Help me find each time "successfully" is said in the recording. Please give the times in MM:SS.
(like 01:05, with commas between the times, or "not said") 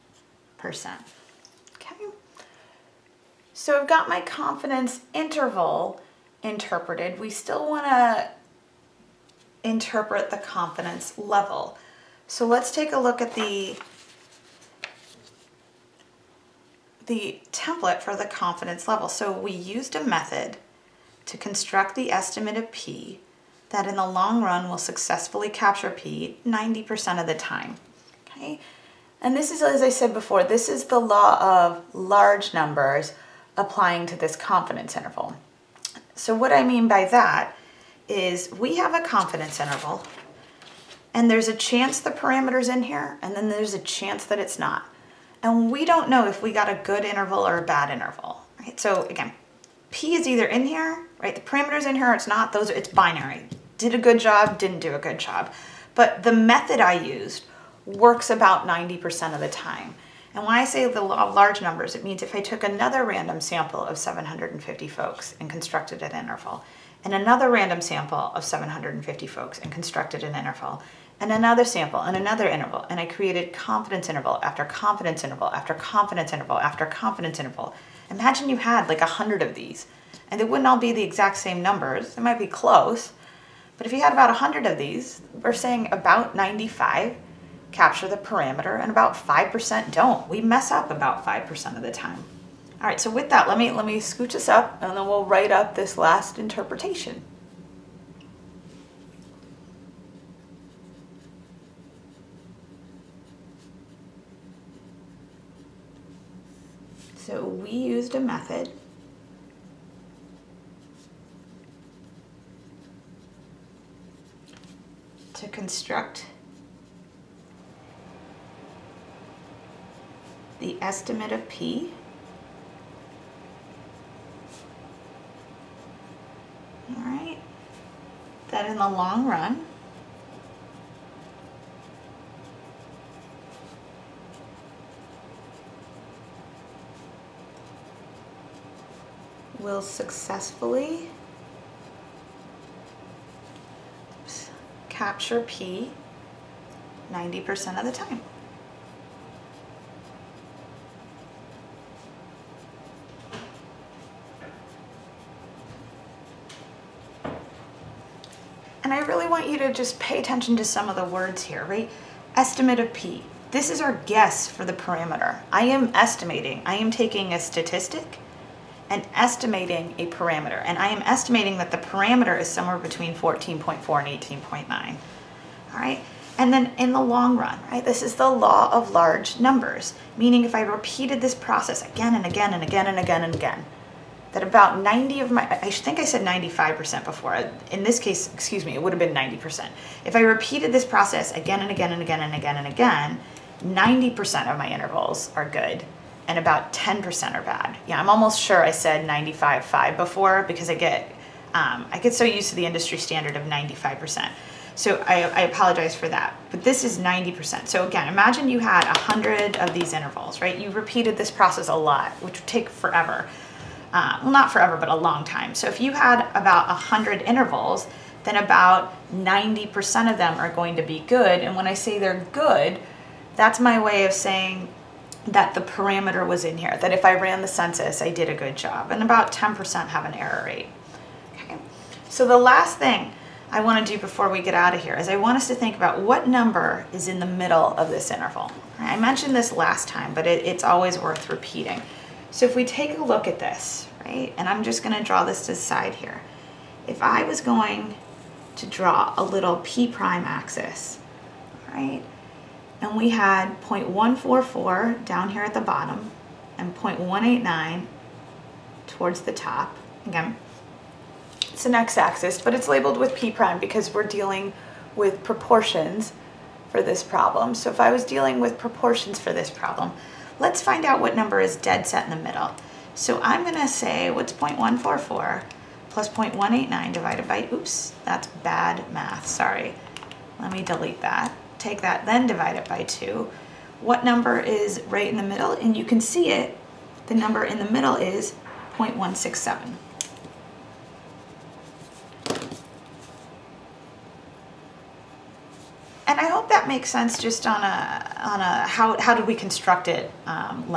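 00:24, 02:19.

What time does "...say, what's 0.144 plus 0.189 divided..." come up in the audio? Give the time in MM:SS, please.
04:33.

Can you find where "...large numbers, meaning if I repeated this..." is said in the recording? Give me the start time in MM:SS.
02:58.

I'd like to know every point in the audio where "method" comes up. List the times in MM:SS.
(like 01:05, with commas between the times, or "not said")
00:20, 00:56, 01:48.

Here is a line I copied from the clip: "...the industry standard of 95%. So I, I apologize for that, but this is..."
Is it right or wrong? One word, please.
right.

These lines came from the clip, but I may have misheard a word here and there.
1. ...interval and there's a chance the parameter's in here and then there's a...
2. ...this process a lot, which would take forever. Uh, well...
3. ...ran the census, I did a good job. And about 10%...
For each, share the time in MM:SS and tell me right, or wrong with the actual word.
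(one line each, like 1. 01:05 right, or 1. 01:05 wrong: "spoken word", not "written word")
1. 00:39 right
2. 03:31 right
3. 03:47 right.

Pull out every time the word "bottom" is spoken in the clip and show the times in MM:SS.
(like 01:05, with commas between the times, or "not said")
04:15.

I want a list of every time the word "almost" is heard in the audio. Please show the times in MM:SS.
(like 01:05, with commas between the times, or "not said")
03:18.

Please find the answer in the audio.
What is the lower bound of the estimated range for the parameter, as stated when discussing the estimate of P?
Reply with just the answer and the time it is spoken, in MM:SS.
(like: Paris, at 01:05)
14.4, at 02:53.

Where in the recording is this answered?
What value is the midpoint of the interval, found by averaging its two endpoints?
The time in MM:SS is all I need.
04:48.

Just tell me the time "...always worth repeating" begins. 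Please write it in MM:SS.
04:00.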